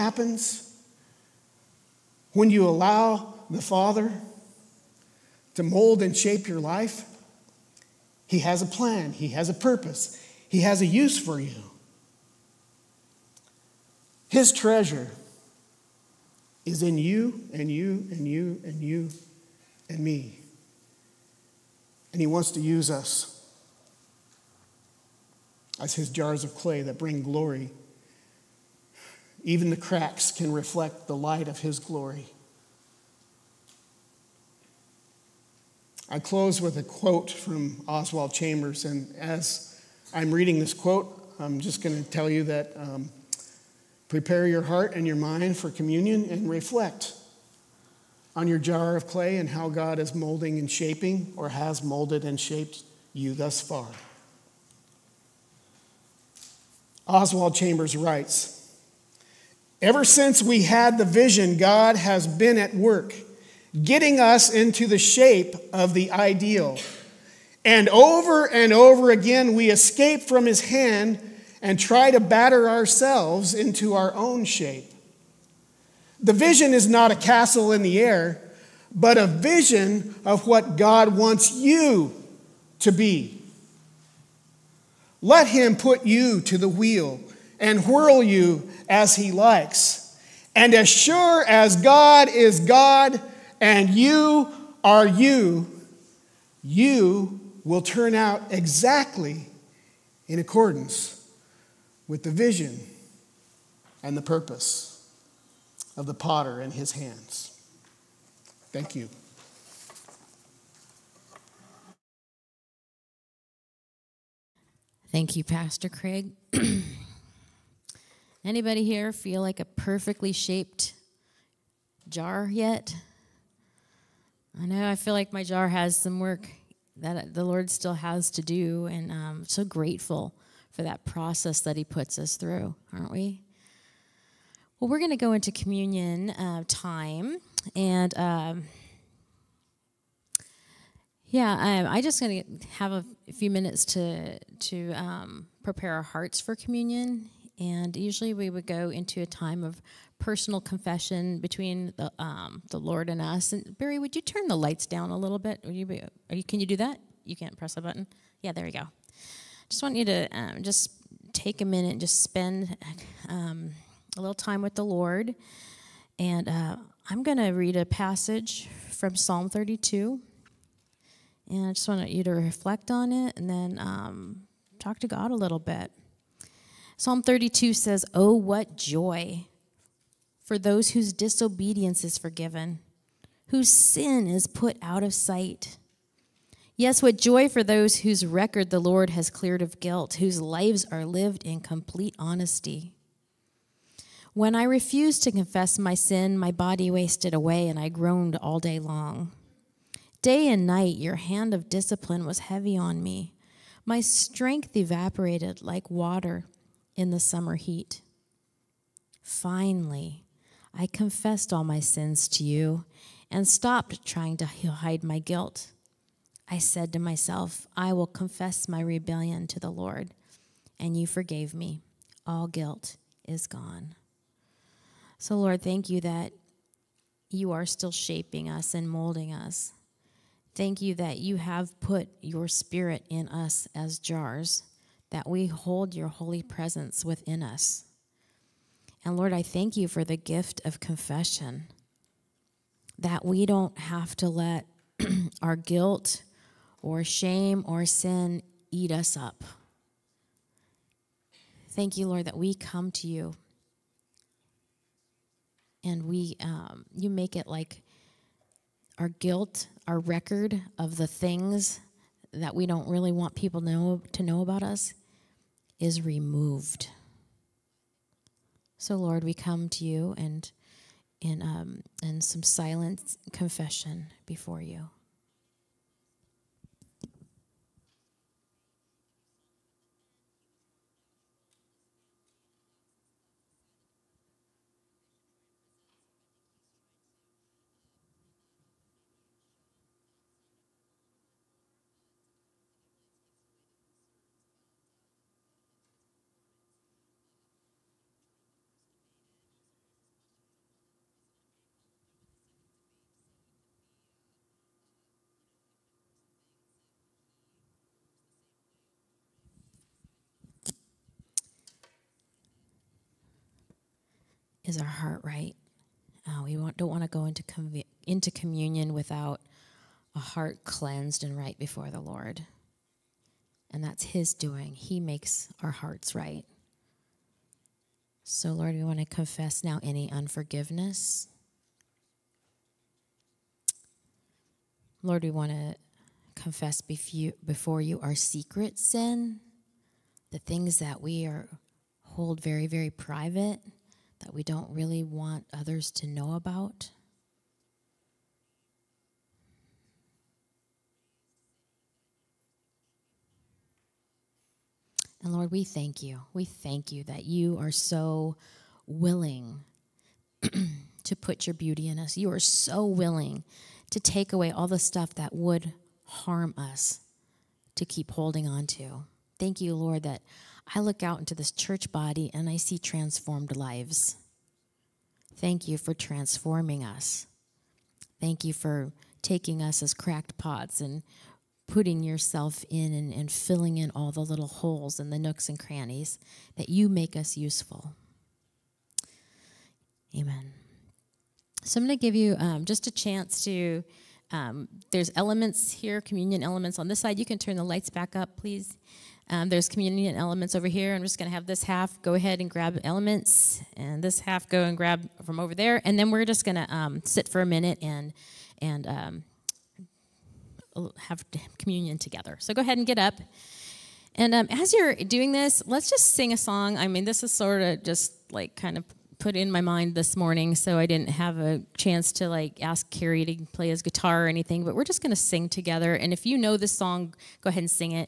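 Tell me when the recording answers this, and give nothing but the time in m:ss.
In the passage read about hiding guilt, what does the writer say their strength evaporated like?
3:25.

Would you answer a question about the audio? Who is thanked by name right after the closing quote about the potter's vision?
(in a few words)
Pastor Craig.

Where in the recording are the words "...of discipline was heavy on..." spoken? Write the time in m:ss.
3:21.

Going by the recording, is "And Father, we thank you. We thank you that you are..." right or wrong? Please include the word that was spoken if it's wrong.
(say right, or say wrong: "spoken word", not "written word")
wrong: "Lord", not "Father".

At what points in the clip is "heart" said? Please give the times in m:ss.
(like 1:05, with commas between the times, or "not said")
0:44, 2:26, 5:14, 5:20, 5:25.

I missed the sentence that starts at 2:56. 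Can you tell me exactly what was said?
Psalm 32 says, Oh, what joy for those whose disobedience is forgiven, whose sin is put out of sight.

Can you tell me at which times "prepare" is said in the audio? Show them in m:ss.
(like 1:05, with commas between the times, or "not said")
0:44, 2:25.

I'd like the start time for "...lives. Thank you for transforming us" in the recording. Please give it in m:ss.
6:13.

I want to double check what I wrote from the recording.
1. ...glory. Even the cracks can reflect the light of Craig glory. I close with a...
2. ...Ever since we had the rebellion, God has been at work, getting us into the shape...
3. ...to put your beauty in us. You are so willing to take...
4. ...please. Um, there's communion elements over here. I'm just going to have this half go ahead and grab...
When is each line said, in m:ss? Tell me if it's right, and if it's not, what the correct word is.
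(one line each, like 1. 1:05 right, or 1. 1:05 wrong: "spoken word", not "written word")
1. 0:27 wrong: "His", not "Craig"
2. 0:59 wrong: "vision", not "rebellion"
3. 6:01 right
4. 6:38 right.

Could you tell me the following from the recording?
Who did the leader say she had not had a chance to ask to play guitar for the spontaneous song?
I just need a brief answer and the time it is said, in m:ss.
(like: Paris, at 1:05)
Carrie, at 7:02.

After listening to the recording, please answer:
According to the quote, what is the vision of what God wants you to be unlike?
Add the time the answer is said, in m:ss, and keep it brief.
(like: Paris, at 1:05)
a castle in the air, at 1:17.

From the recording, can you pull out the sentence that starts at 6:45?
And then we're just going to um, sit for a minute and and um, have communion together.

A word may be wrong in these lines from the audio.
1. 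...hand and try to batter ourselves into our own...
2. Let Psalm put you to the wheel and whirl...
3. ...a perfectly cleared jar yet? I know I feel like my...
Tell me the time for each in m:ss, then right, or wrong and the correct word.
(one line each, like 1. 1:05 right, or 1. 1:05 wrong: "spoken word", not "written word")
1. 1:10 right
2. 1:25 wrong: "Him", not "Psalm"
3. 1:59 wrong: "shaped", not "cleared".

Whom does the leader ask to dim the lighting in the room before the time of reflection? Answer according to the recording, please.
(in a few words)
Barry.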